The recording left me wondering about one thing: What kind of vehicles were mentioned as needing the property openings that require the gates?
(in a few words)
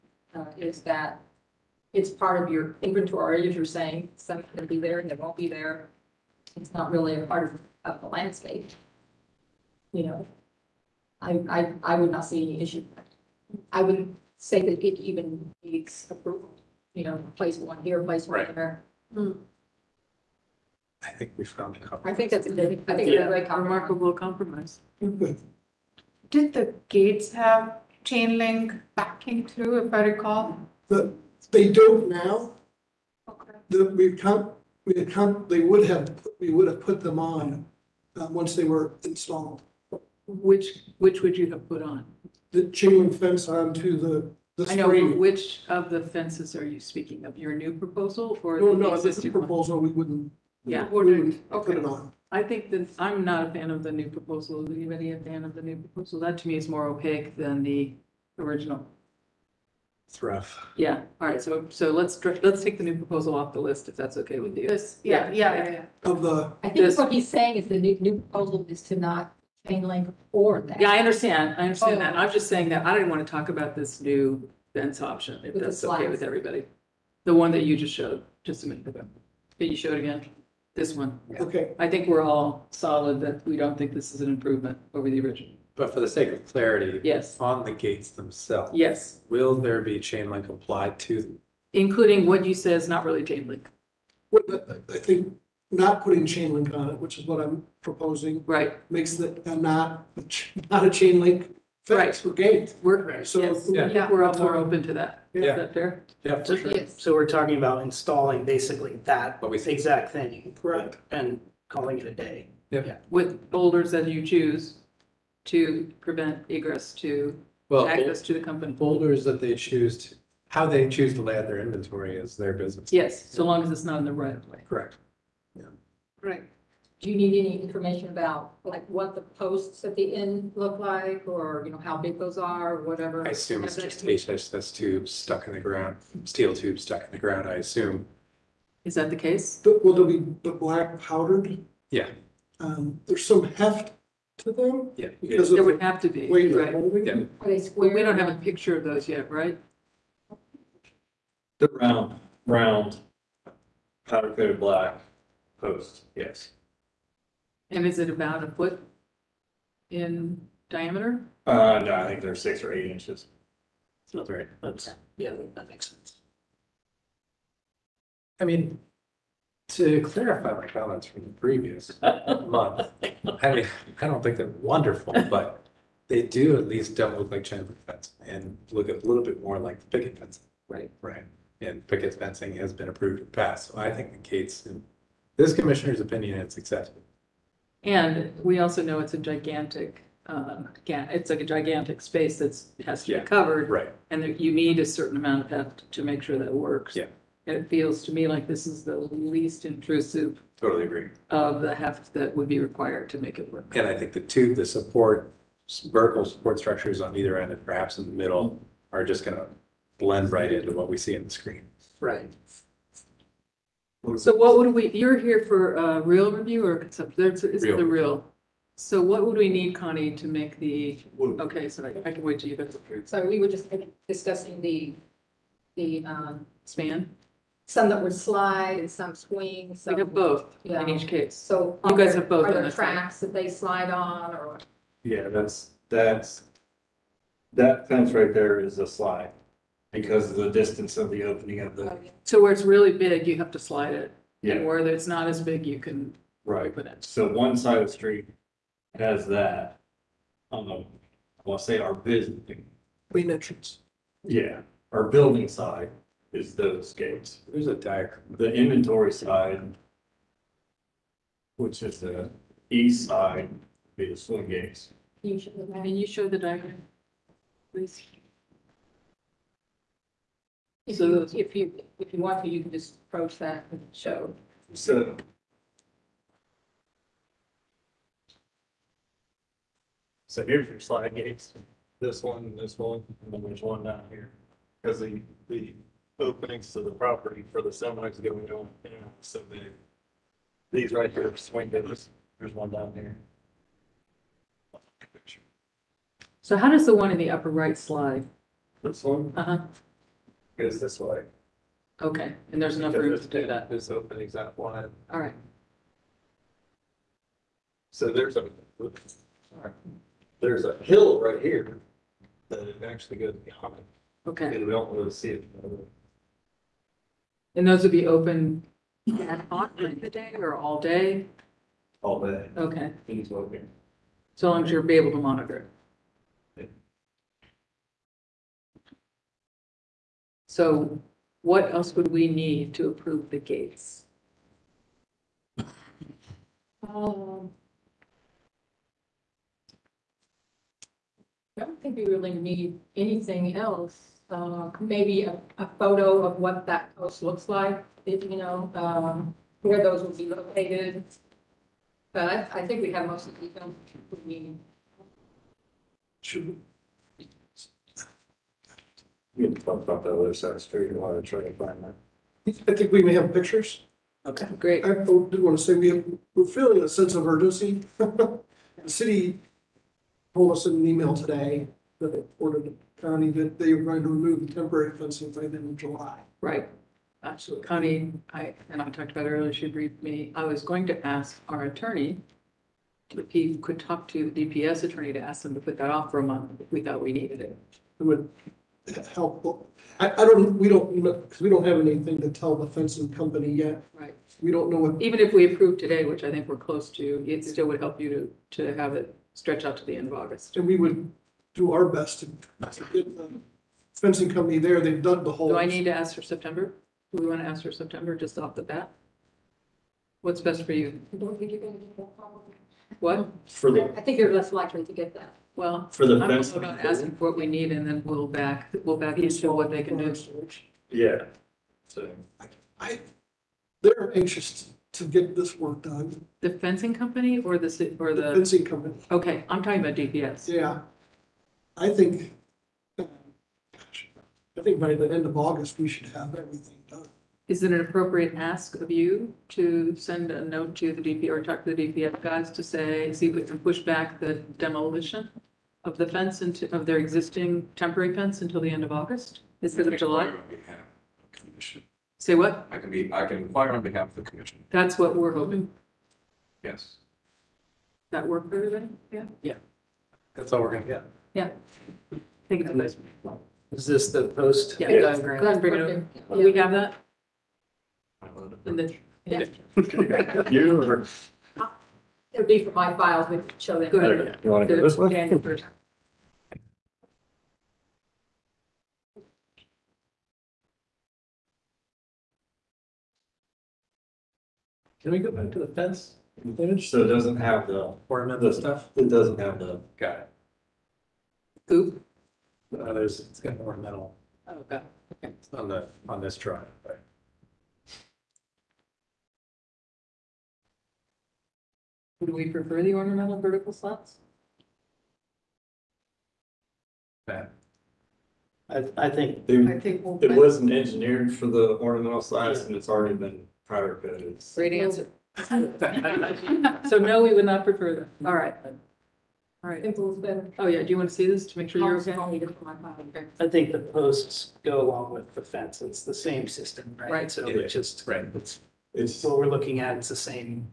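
Semis.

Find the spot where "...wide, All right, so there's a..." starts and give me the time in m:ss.
5:04.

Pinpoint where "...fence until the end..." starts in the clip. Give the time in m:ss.
7:28.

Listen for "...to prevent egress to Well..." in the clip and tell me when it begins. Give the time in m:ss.
1:55.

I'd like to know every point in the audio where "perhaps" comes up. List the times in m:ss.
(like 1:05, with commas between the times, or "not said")
3:27.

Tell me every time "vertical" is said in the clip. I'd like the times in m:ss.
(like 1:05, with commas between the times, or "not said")
3:25, 8:23.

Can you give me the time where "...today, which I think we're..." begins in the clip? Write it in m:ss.
6:35.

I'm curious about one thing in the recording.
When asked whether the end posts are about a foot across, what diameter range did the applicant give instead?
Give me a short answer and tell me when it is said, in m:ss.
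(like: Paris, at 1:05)
6 or 8 inches, at 2:42.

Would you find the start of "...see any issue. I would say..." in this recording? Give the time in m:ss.
0:12.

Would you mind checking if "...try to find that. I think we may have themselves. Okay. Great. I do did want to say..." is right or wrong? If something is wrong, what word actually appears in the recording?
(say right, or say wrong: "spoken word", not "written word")
wrong: "pictures", not "themselves".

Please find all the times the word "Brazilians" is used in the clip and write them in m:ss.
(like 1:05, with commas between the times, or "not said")
not said.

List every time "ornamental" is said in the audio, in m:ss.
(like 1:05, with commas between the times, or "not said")
8:22, 8:31.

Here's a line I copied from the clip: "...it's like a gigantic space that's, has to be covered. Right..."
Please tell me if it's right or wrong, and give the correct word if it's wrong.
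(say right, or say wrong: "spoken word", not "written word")
right.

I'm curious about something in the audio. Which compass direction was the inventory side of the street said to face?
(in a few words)
East.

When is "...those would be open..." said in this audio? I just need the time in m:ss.
5:17.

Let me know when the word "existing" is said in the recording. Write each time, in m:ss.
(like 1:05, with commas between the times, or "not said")
0:49, 7:26.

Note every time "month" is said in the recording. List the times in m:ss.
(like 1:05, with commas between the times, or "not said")
2:52, 6:26.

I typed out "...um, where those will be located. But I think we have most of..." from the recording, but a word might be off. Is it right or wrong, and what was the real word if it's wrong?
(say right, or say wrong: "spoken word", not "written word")
right.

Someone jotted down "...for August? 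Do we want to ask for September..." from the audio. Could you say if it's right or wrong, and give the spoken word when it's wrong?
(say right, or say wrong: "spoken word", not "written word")
wrong: "September", not "August".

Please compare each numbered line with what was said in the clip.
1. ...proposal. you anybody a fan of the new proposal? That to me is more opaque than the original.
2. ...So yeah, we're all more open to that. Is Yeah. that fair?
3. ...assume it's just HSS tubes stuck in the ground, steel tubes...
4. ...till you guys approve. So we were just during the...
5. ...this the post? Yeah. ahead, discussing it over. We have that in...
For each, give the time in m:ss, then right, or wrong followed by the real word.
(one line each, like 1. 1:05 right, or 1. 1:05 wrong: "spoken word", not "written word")
1. 0:54 right
2. 1:43 right
3. 2:13 right
4. 3:42 wrong: "discussing", not "during"
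5. 7:43 wrong: "bring", not "discussing".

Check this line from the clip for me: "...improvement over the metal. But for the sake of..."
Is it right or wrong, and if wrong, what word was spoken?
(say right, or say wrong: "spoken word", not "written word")
wrong: "original", not "metal".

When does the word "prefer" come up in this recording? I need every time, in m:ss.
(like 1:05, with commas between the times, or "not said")
8:22, 8:37.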